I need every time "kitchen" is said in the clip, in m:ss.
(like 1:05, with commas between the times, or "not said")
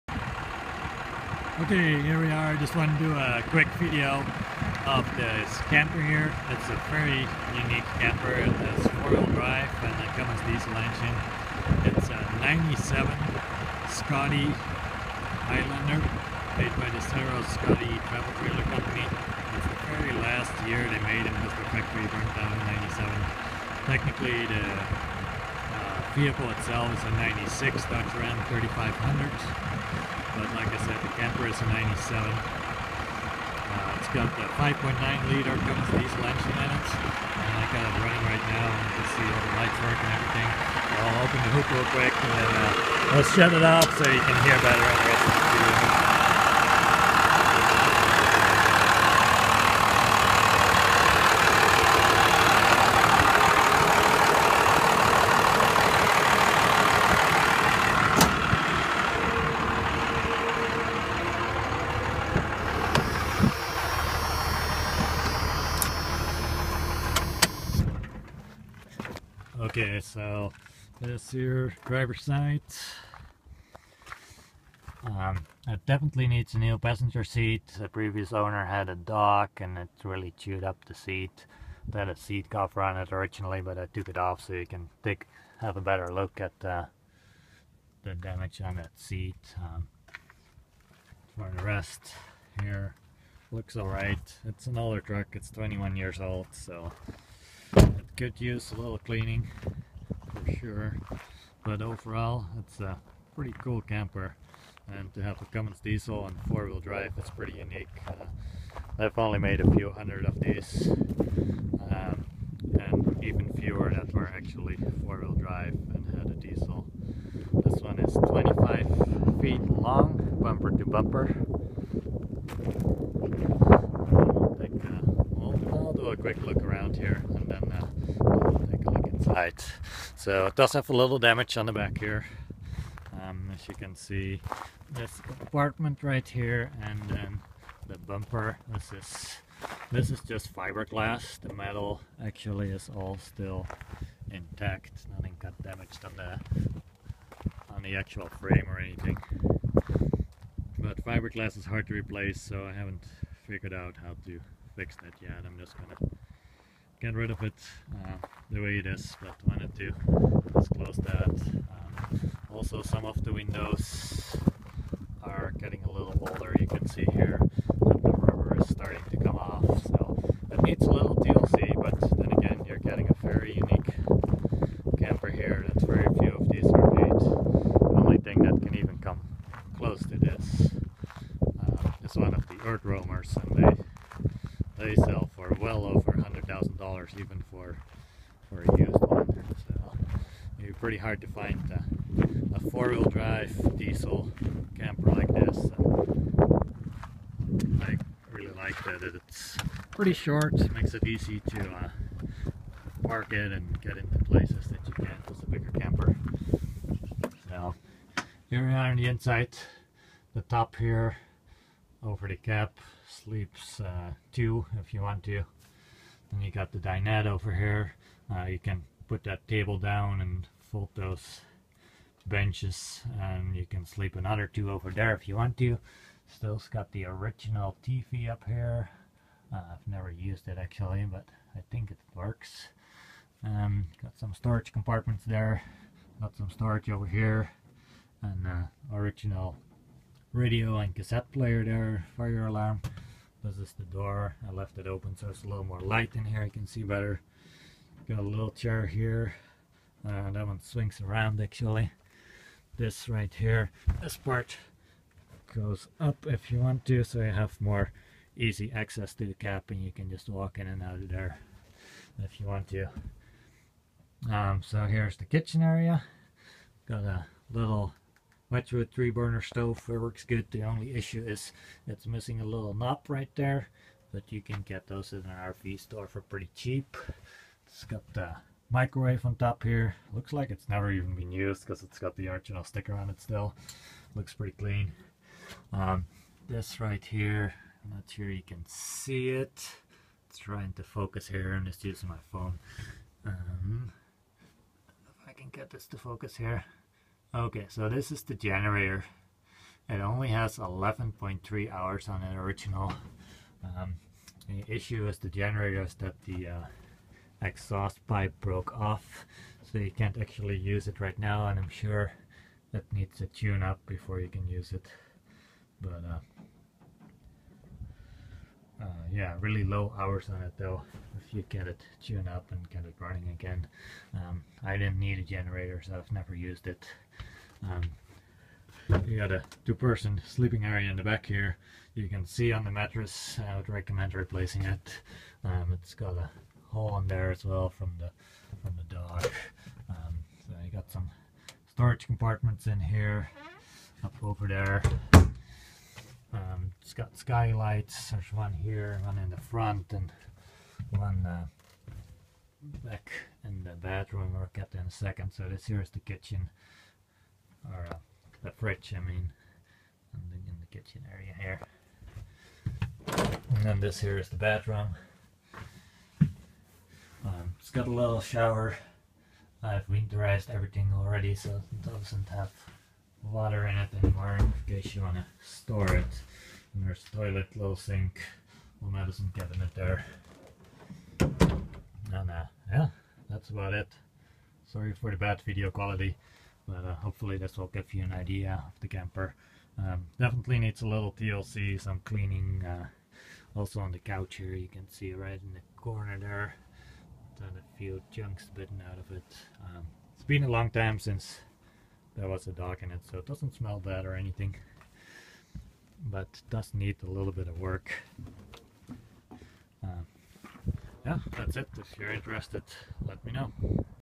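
4:25, 5:55, 6:00.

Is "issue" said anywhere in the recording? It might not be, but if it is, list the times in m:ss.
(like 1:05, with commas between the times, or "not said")
4:30, 5:04.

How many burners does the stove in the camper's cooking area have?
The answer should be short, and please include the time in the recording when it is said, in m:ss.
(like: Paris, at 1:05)
3, at 4:28.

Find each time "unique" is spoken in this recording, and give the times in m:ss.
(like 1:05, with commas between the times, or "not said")
0:07, 1:47, 2:53.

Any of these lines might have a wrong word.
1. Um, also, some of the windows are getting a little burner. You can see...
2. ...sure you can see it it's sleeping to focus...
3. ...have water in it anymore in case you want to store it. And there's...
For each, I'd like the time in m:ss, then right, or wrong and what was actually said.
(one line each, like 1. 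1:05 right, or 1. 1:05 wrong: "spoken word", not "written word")
1. 2:41 wrong: "older", not "burner"
2. 4:48 wrong: "trying", not "sleeping"
3. 6:12 right.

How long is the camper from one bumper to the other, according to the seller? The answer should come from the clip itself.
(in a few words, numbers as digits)
25 feet.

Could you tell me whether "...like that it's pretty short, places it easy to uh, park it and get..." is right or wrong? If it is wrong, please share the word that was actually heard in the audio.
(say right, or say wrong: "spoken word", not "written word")
wrong: "makes", not "places".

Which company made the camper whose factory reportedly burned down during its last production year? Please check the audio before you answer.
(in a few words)
Serro Scotty Travel Trailer Company.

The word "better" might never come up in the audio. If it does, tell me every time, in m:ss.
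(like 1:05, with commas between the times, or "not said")
0:44, 1:25, 4:06.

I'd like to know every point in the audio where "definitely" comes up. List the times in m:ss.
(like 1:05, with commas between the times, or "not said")
1:15, 6:30.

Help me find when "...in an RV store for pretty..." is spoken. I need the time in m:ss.
4:35.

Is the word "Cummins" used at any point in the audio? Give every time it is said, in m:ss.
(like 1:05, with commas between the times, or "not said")
0:10, 0:35, 1:45.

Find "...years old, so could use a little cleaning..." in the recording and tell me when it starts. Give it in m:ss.
1:35.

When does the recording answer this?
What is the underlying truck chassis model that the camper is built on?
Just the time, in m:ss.
0:27.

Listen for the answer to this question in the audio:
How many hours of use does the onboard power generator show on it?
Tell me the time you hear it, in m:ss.
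5:00.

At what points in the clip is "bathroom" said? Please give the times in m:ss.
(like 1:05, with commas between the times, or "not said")
5:53, 6:04.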